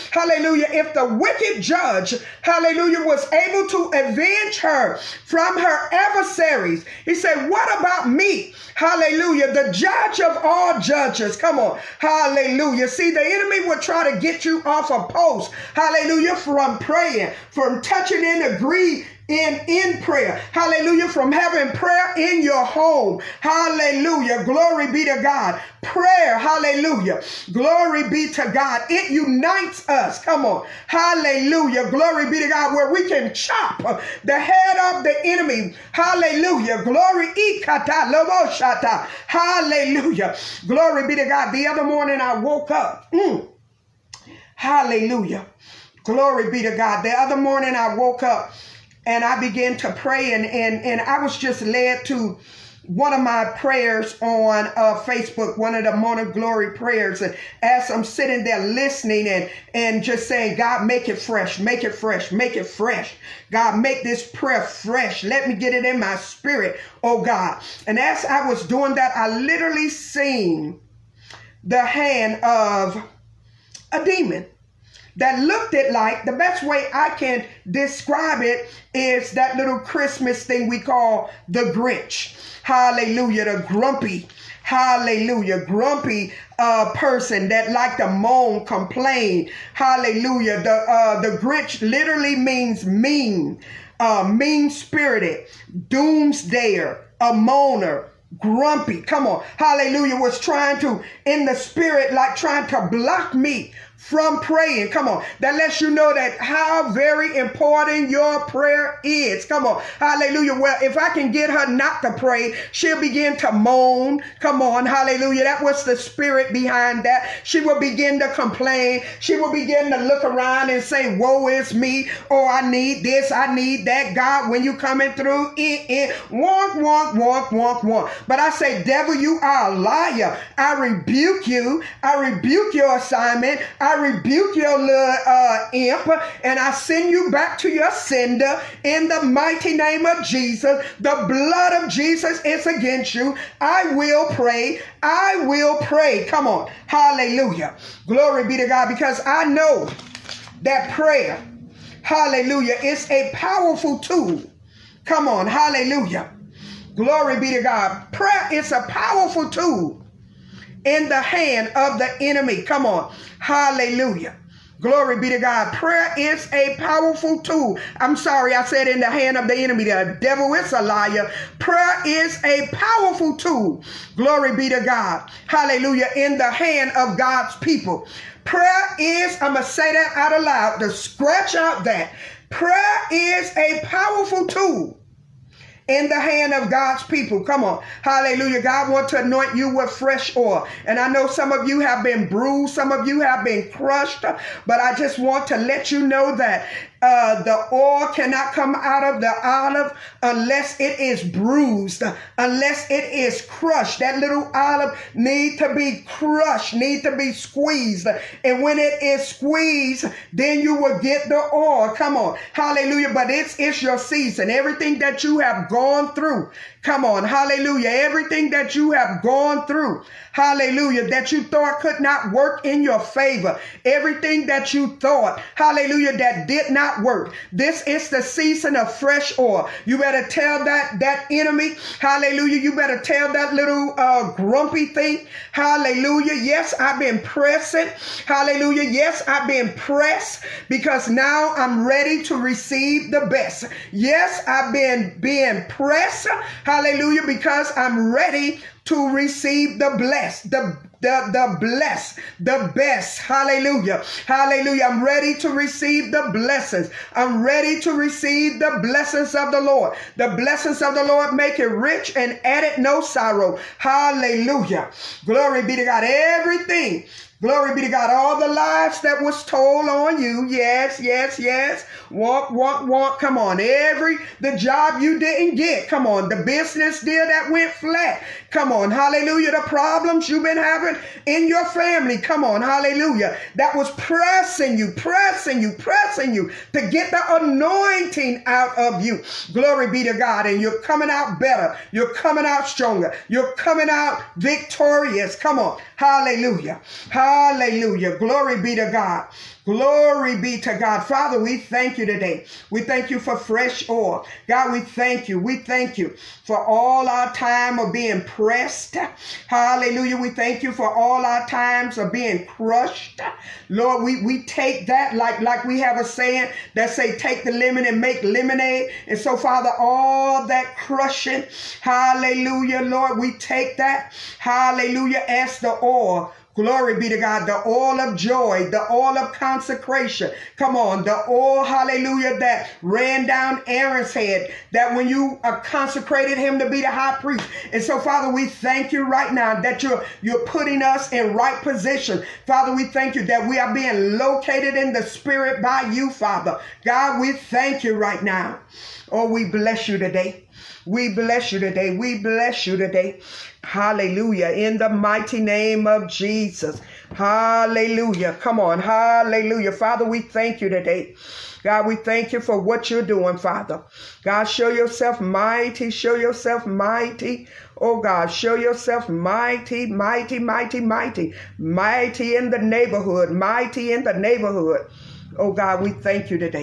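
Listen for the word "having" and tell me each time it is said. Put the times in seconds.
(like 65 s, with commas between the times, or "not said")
21 s, 280 s.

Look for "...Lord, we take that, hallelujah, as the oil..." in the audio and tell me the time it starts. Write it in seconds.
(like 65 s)
322 s.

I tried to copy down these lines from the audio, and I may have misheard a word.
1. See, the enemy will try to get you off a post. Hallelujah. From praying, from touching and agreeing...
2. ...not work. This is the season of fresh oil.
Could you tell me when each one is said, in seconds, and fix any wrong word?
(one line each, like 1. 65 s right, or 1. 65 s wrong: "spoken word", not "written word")
1. 12 s right
2. 226 s right.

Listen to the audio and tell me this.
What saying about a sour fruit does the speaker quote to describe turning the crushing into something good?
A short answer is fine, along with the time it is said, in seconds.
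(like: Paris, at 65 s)
Take the lemon and make lemonade, at 317 s.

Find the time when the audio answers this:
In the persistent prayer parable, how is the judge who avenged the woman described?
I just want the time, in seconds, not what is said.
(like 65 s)
1 s.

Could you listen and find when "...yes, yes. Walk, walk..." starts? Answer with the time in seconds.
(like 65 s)
270 s.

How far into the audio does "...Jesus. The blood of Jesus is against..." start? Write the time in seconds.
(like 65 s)
140 s.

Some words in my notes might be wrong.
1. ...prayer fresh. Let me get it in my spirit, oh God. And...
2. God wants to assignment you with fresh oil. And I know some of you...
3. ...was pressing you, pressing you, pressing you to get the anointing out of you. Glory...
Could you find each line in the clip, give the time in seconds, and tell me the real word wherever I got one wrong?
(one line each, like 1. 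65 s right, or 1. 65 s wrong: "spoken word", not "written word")
1. 64 s right
2. 188 s wrong: "anoint", not "assignment"
3. 283 s right.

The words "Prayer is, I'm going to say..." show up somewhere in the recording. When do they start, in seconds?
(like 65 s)
178 s.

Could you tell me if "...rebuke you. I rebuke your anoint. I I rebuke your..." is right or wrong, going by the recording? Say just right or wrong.
wrong.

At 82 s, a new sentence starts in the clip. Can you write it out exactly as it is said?
Hallelujah, the grumpy hallelujah, grumpy uh, person that like to moan, complain, hallelujah.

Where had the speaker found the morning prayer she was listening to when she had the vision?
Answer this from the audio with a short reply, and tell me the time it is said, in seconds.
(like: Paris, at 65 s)
Facebook, at 55 s.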